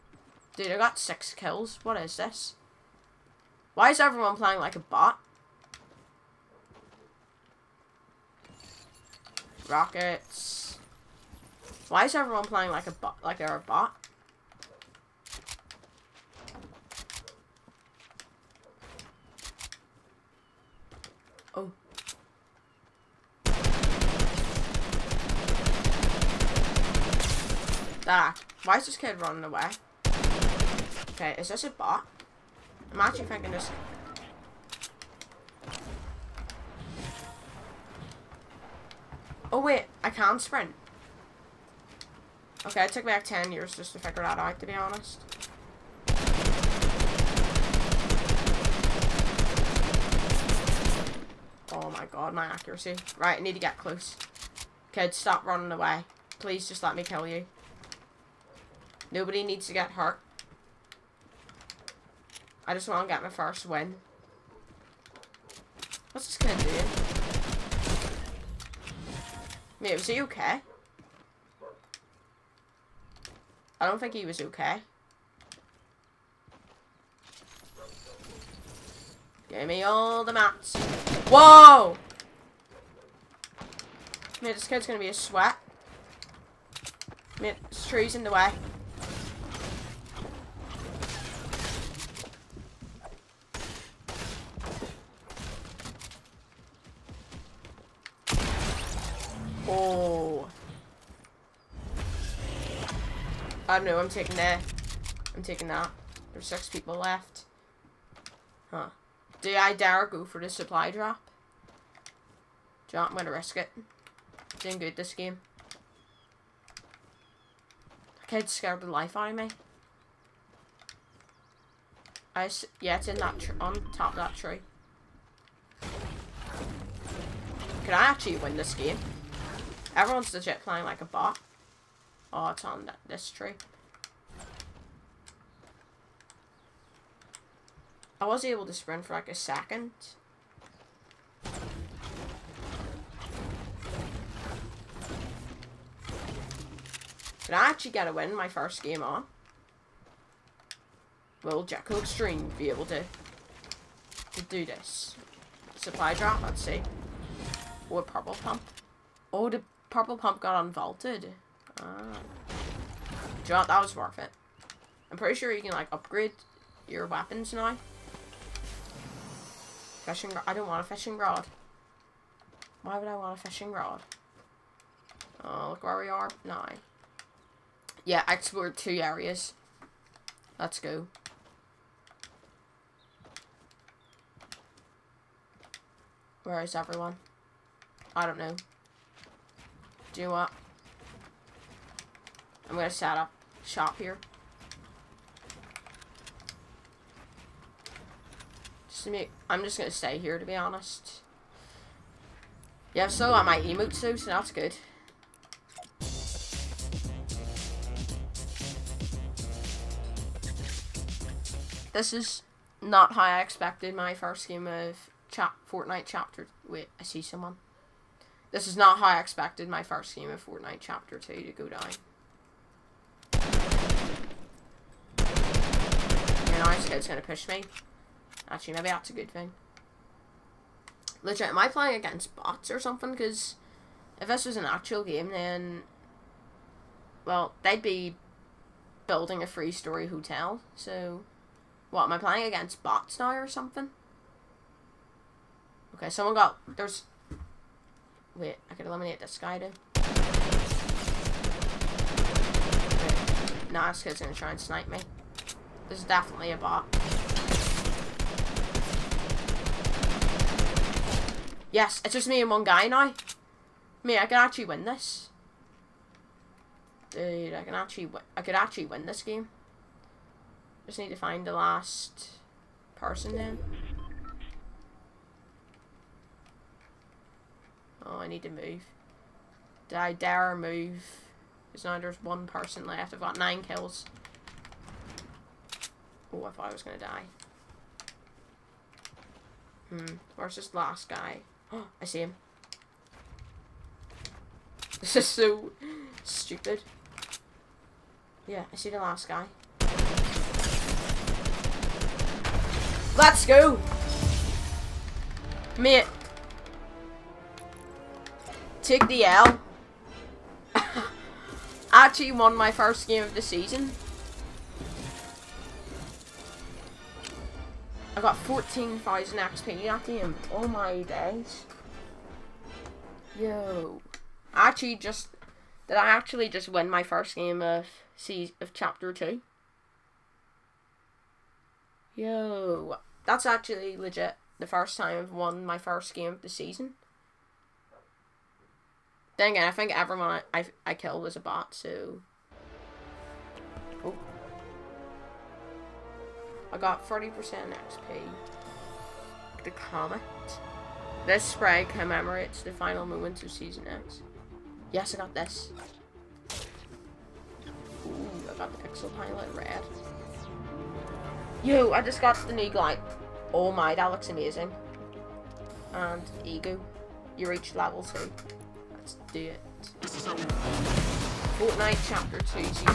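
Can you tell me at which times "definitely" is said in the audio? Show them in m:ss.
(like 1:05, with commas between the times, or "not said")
4:16.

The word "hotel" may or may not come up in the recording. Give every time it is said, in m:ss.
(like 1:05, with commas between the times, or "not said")
4:00.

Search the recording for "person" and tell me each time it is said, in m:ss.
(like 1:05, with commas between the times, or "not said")
4:32, 4:42.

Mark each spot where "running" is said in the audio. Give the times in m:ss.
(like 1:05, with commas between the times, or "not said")
0:29, 0:55.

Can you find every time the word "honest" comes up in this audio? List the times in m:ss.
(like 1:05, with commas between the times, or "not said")
0:44, 3:20.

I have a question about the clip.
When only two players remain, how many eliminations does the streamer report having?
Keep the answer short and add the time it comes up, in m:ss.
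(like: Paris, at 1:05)
9, at 4:43.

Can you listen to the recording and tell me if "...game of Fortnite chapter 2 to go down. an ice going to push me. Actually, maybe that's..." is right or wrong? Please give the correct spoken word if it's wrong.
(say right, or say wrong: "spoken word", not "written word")
right.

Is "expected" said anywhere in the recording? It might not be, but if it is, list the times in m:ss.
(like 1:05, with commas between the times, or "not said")
3:33, 3:39.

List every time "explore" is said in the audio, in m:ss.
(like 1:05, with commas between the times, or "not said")
2:58.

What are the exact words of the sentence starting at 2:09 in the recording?
Everyone's legit playing like a bot.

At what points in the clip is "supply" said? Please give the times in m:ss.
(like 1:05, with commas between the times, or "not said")
1:50, 2:35.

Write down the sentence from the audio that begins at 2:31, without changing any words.
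Will Jackal Extreme be able to, to do this?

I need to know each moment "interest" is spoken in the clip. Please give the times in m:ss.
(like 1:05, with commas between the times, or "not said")
not said.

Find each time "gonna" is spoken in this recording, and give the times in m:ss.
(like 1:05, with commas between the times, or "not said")
1:06, 1:24, 1:53, 3:12, 3:19, 4:14, 4:46.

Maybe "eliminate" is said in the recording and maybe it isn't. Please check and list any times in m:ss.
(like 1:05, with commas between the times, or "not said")
4:08.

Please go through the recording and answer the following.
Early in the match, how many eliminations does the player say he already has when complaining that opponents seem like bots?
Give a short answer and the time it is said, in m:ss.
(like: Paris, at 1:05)
6, at 0:00.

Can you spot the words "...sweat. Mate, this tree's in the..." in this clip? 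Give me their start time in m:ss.
1:25.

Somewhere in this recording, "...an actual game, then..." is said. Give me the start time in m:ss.
3:54.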